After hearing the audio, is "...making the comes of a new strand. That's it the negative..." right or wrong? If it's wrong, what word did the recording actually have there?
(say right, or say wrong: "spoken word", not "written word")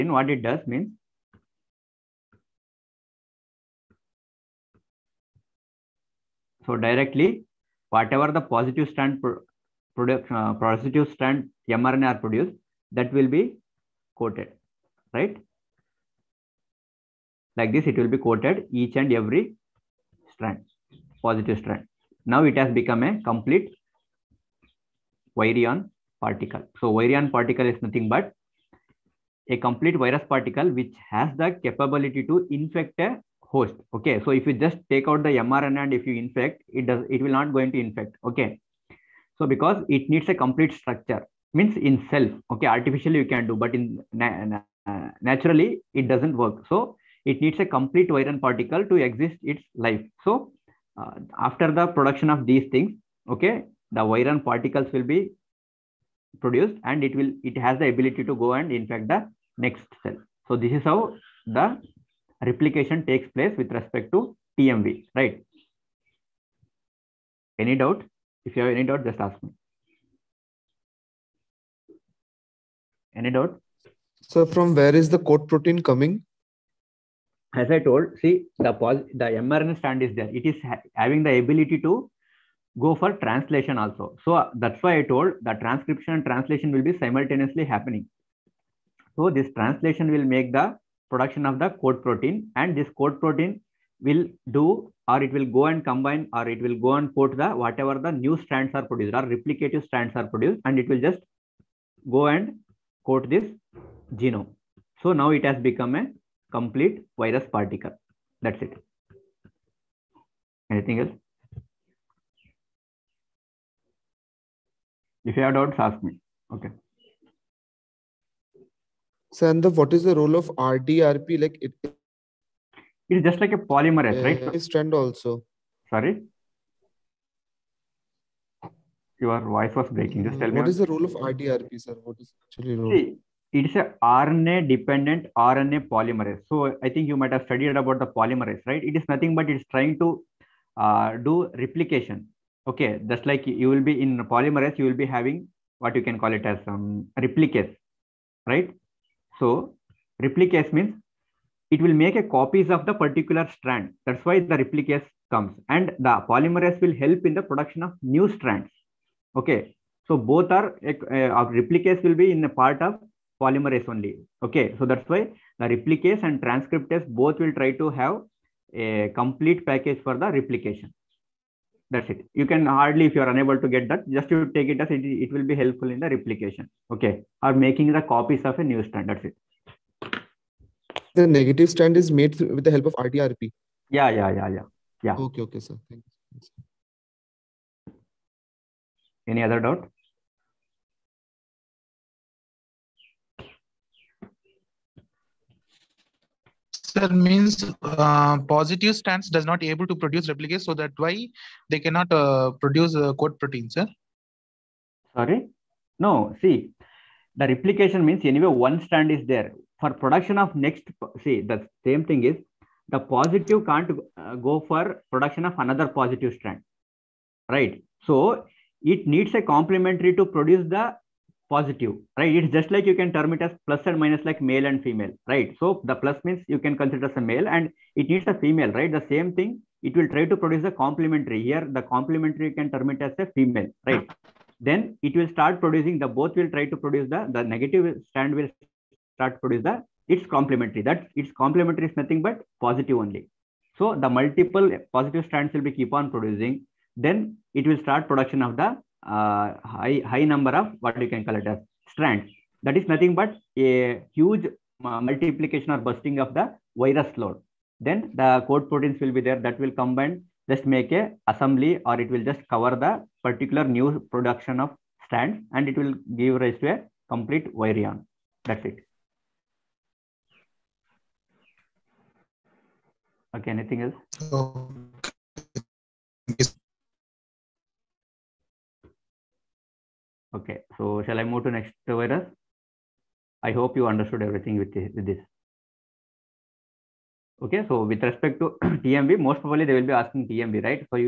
wrong: "copies", not "comes".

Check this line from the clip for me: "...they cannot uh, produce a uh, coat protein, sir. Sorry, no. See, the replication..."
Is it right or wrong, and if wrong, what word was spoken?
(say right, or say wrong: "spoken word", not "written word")
right.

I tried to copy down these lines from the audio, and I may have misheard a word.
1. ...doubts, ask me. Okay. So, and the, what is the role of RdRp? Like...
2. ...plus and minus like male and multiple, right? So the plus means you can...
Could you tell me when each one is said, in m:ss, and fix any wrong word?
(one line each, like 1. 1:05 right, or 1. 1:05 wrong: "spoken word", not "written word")
1. 1:55 right
2. 3:43 wrong: "female", not "multiple".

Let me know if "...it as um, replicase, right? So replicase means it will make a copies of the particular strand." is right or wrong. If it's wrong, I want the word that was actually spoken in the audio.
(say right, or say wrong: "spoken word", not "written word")
right.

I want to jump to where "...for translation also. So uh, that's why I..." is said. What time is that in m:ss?
1:22.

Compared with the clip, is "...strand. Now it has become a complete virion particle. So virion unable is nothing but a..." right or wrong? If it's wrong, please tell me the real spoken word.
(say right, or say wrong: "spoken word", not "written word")
wrong: "particle", not "unable".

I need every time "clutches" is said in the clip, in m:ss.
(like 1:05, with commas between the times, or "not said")
not said.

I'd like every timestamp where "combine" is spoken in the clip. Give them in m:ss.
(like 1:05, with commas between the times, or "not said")
1:35, 4:19.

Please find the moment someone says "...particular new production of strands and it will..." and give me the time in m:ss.
4:23.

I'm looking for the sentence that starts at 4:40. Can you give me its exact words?
okay, so shall I move to next virus?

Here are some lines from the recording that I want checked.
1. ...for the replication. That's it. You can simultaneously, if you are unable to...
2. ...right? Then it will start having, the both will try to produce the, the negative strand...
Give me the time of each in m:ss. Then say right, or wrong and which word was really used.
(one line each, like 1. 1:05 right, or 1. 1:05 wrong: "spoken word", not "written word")
1. 2:50 wrong: "hardly", not "simultaneously"
2. 3:53 wrong: "producing", not "having".